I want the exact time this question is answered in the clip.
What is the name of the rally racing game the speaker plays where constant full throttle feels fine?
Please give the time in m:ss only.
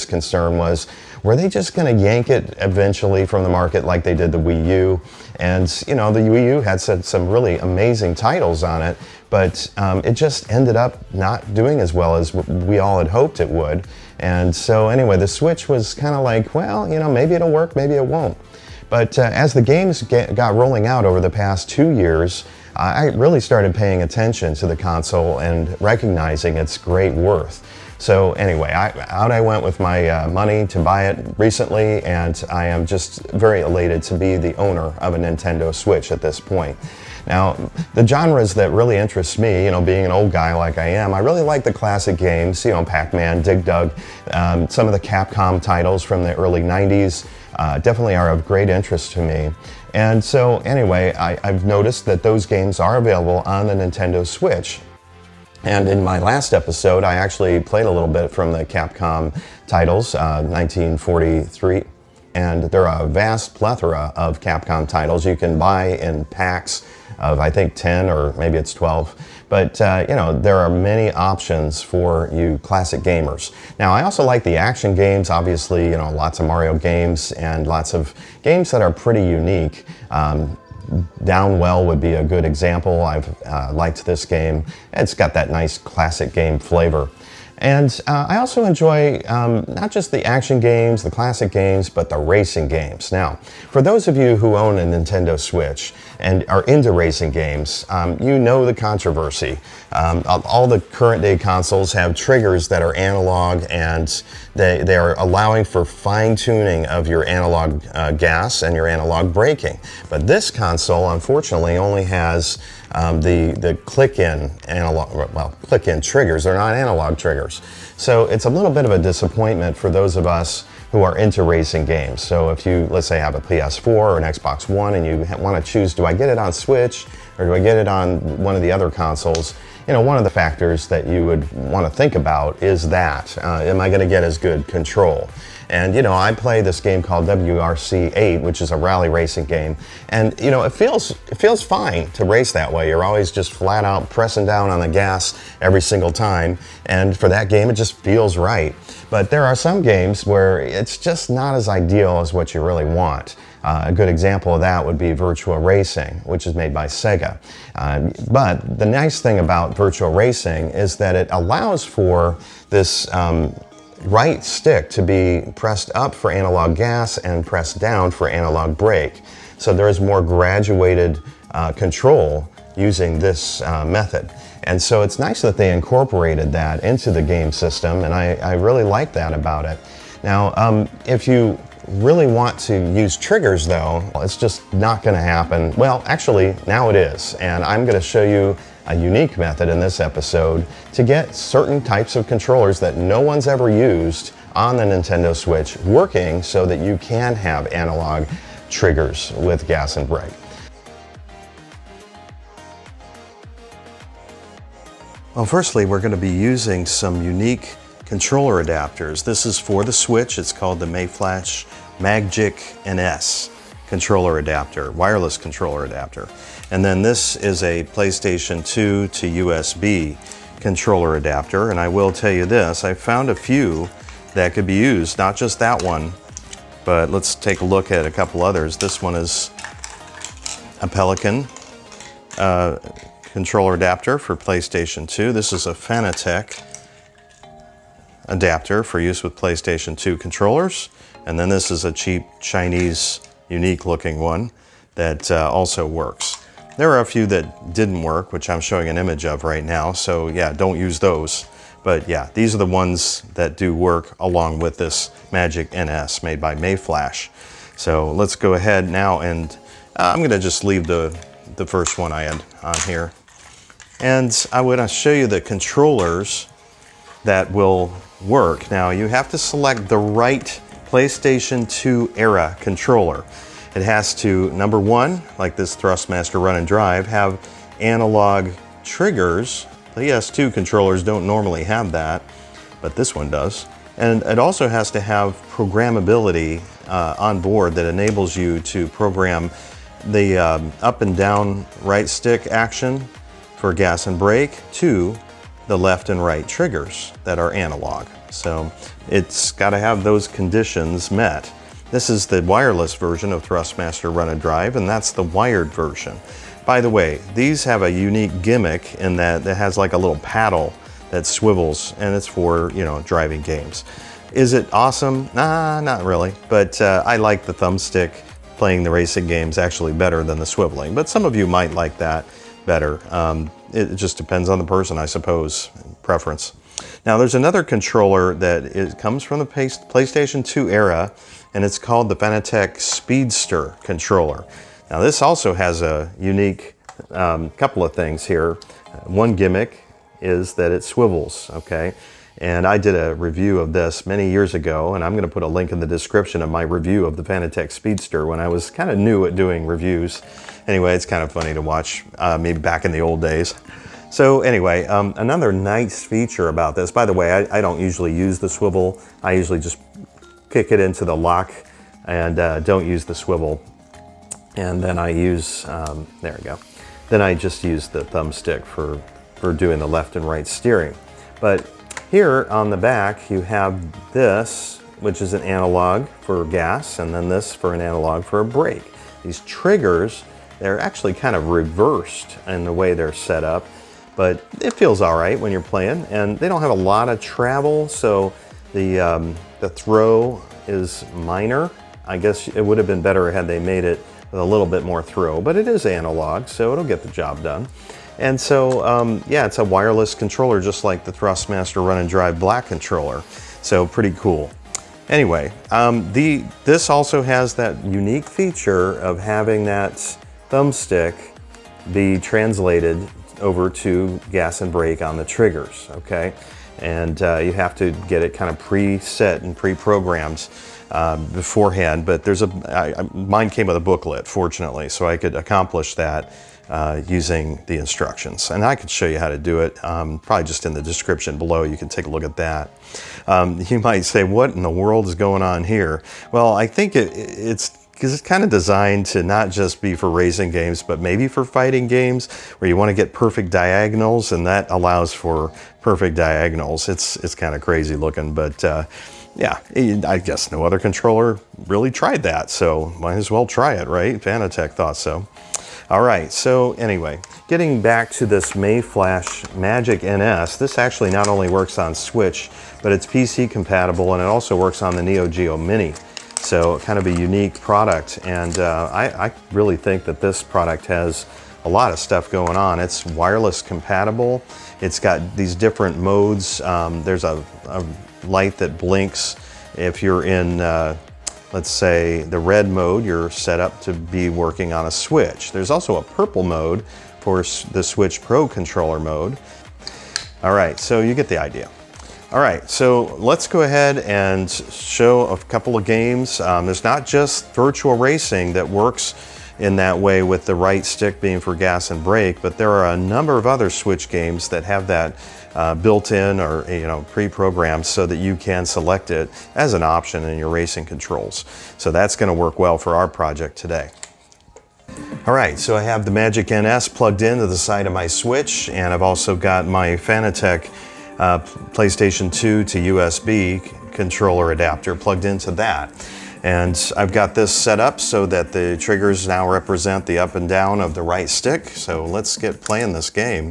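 2:17.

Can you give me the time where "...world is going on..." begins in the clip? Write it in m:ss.
7:14.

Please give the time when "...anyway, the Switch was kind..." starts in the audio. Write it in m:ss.
0:14.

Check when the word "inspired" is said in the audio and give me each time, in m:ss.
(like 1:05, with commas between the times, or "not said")
not said.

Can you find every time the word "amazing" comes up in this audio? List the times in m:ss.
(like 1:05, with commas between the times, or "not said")
0:07.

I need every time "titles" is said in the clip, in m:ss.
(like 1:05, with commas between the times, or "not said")
0:08, 0:45, 0:59, 1:04.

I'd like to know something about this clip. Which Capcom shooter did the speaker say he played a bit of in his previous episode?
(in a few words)
1943.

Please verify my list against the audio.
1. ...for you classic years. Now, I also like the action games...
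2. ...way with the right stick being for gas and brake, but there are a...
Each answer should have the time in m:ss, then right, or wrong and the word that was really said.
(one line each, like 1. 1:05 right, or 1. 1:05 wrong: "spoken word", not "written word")
1. 1:11 wrong: "gamers", not "years"
2. 8:19 right.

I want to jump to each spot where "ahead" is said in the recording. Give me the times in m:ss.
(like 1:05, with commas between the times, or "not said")
4:18, 8:13.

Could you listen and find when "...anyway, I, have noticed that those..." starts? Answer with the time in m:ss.
0:50.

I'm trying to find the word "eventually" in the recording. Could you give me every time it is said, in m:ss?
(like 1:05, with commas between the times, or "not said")
0:02.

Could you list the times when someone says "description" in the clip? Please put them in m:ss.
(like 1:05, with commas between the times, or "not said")
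5:45, 7:10.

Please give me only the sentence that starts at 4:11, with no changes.
But yeah, these are the ones that do work along with this Magic NS made by Mayflash.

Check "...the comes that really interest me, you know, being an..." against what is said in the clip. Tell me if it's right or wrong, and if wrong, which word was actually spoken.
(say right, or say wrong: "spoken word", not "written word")
wrong: "genres", not "comes".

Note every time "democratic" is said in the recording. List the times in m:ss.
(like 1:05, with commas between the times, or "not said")
not said.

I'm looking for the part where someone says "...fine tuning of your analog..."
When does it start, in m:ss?
1:45.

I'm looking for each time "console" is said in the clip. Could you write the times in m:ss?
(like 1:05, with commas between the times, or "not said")
0:24, 1:41, 1:50, 2:08.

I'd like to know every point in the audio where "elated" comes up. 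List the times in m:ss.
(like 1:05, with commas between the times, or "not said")
0:33.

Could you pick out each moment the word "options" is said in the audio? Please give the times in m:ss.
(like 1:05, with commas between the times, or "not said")
1:11, 8:29.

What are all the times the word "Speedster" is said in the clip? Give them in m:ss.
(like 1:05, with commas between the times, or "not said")
5:32, 5:47.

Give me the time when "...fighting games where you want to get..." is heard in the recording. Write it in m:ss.
7:21.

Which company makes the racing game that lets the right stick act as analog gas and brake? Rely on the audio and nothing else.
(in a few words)
Sega.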